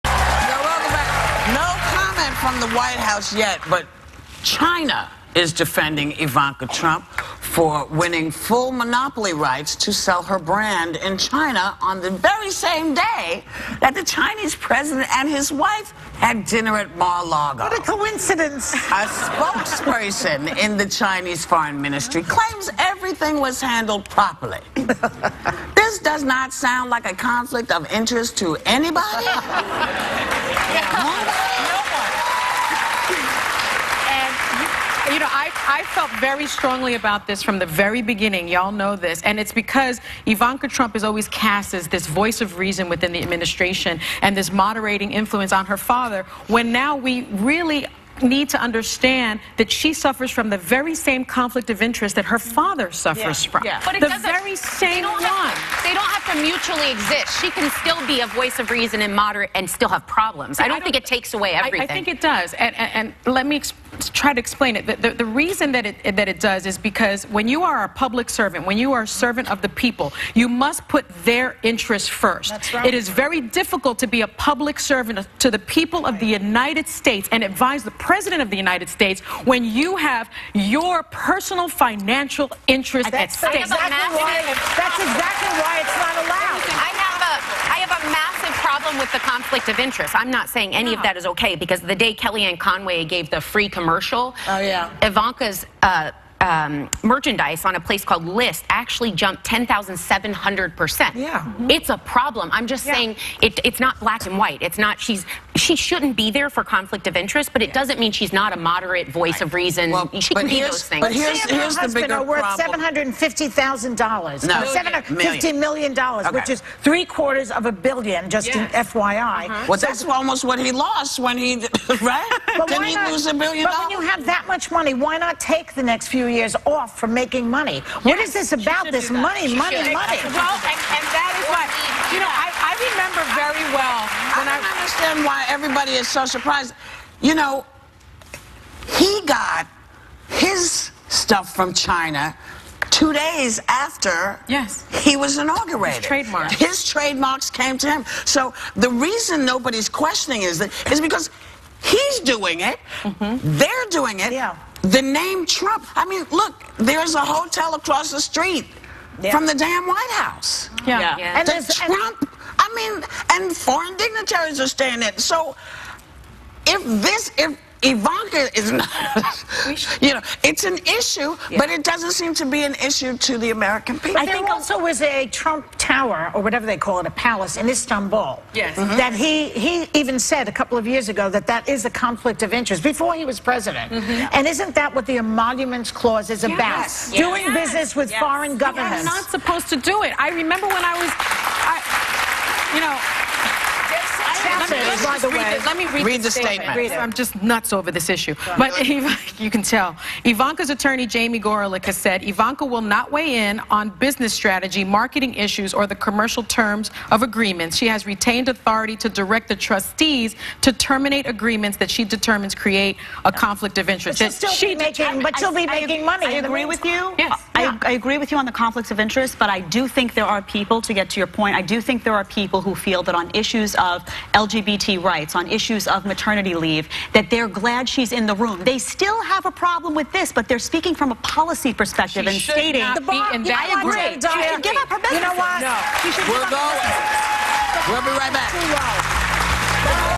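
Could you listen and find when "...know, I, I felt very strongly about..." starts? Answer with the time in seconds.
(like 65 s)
35 s.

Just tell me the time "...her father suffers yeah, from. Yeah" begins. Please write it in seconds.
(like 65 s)
52 s.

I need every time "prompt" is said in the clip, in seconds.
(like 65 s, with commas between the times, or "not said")
not said.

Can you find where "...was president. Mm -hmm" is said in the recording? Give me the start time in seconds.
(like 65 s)
183 s.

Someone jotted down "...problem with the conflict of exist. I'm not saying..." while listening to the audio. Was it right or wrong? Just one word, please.
wrong.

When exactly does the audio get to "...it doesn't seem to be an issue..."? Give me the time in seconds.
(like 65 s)
171 s.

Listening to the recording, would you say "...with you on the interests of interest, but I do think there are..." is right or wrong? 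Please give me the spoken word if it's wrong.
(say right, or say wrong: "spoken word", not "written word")
wrong: "conflicts", not "interests".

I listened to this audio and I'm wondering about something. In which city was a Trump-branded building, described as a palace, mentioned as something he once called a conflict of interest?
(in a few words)
Istanbul.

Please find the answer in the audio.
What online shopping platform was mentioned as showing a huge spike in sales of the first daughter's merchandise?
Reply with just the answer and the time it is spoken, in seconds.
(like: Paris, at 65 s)
Lyst, at 98 s.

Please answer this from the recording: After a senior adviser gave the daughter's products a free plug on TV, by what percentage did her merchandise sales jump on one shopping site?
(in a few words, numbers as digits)
10,700 percent.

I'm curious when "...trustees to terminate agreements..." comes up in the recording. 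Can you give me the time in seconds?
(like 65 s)
209 s.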